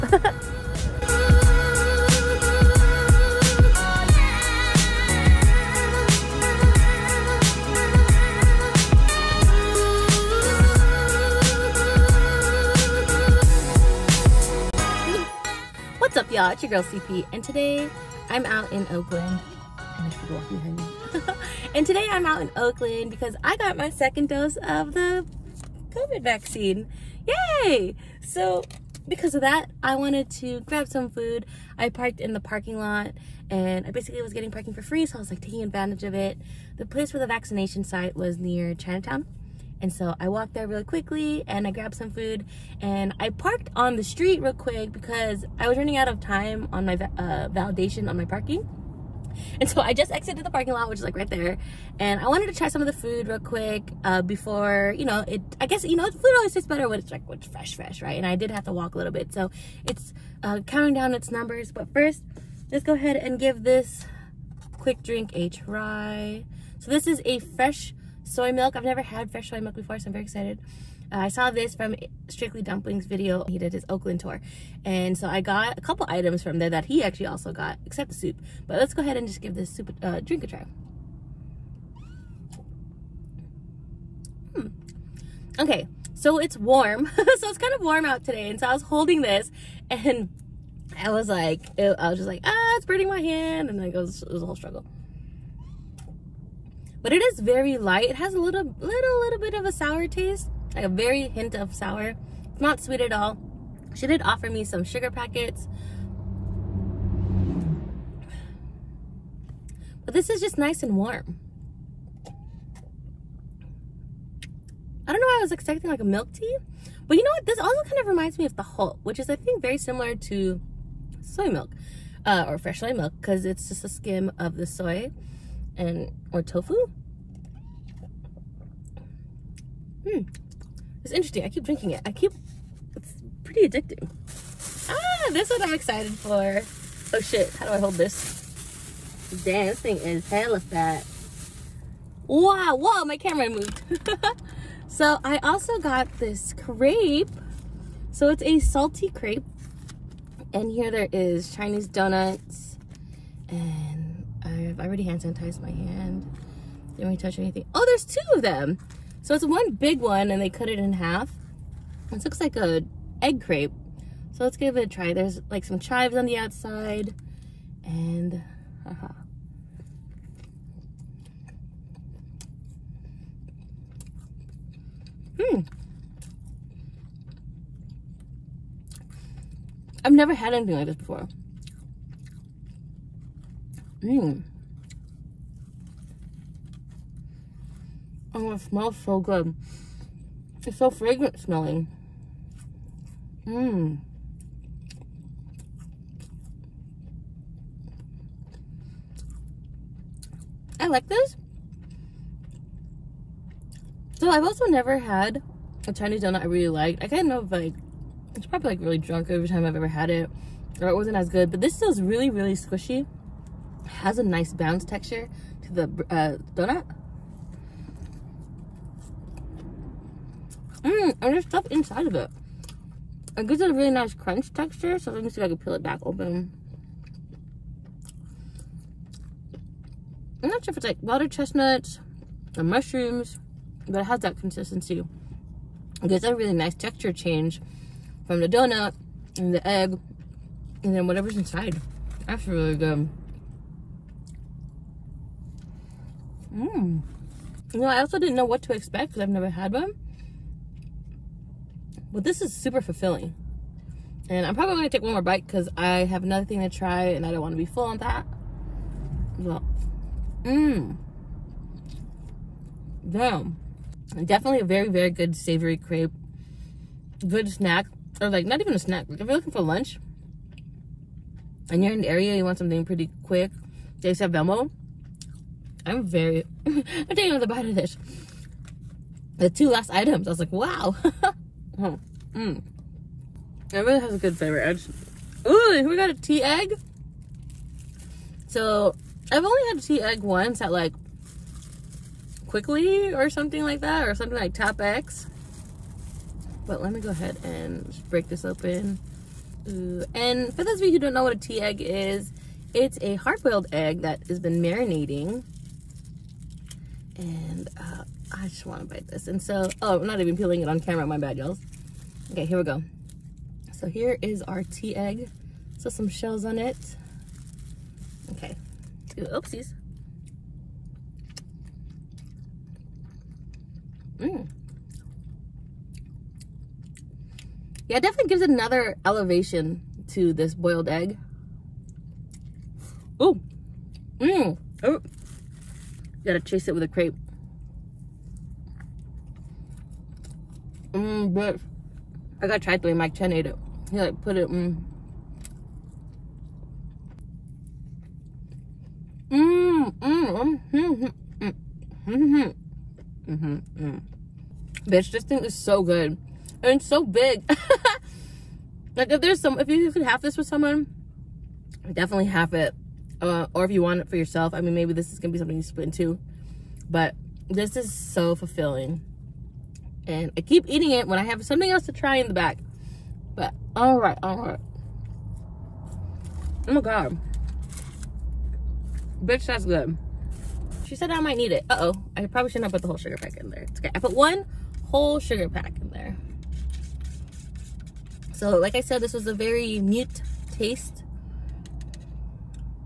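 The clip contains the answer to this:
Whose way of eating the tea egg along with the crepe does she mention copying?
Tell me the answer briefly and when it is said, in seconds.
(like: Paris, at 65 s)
Mike Chen, at 342 s.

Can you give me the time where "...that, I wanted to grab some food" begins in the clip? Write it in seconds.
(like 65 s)
29 s.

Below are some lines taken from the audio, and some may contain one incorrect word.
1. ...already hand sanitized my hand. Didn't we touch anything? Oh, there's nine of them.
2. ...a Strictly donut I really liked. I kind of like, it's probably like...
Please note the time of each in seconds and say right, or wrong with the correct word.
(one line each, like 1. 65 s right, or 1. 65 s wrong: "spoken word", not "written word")
1. 154 s wrong: "two", not "nine"
2. 205 s wrong: "Chinese", not "Strictly".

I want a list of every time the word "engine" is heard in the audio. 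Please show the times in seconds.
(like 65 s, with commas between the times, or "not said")
not said.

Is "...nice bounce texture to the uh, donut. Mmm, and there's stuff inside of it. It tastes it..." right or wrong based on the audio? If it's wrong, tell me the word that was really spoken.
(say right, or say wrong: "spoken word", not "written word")
wrong: "gives", not "tastes".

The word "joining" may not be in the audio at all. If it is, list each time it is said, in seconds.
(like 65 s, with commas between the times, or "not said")
not said.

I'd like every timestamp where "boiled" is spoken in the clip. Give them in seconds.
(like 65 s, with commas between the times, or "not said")
303 s, 330 s.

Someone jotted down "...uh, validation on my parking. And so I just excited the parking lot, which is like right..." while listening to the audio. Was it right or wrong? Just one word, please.
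wrong.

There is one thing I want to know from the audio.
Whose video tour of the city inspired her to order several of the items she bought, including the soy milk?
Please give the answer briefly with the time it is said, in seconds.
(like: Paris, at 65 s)
Strictly Dumpling, at 72 s.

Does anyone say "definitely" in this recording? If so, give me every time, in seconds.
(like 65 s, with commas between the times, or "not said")
264 s, 328 s, 361 s.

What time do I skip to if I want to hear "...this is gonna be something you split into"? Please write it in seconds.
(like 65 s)
364 s.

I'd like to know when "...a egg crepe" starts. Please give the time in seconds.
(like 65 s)
162 s.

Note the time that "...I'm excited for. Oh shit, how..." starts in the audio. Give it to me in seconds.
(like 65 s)
135 s.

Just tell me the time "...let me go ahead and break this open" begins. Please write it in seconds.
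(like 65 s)
296 s.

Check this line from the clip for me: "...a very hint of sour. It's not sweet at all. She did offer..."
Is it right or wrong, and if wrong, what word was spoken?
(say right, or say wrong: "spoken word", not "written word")
right.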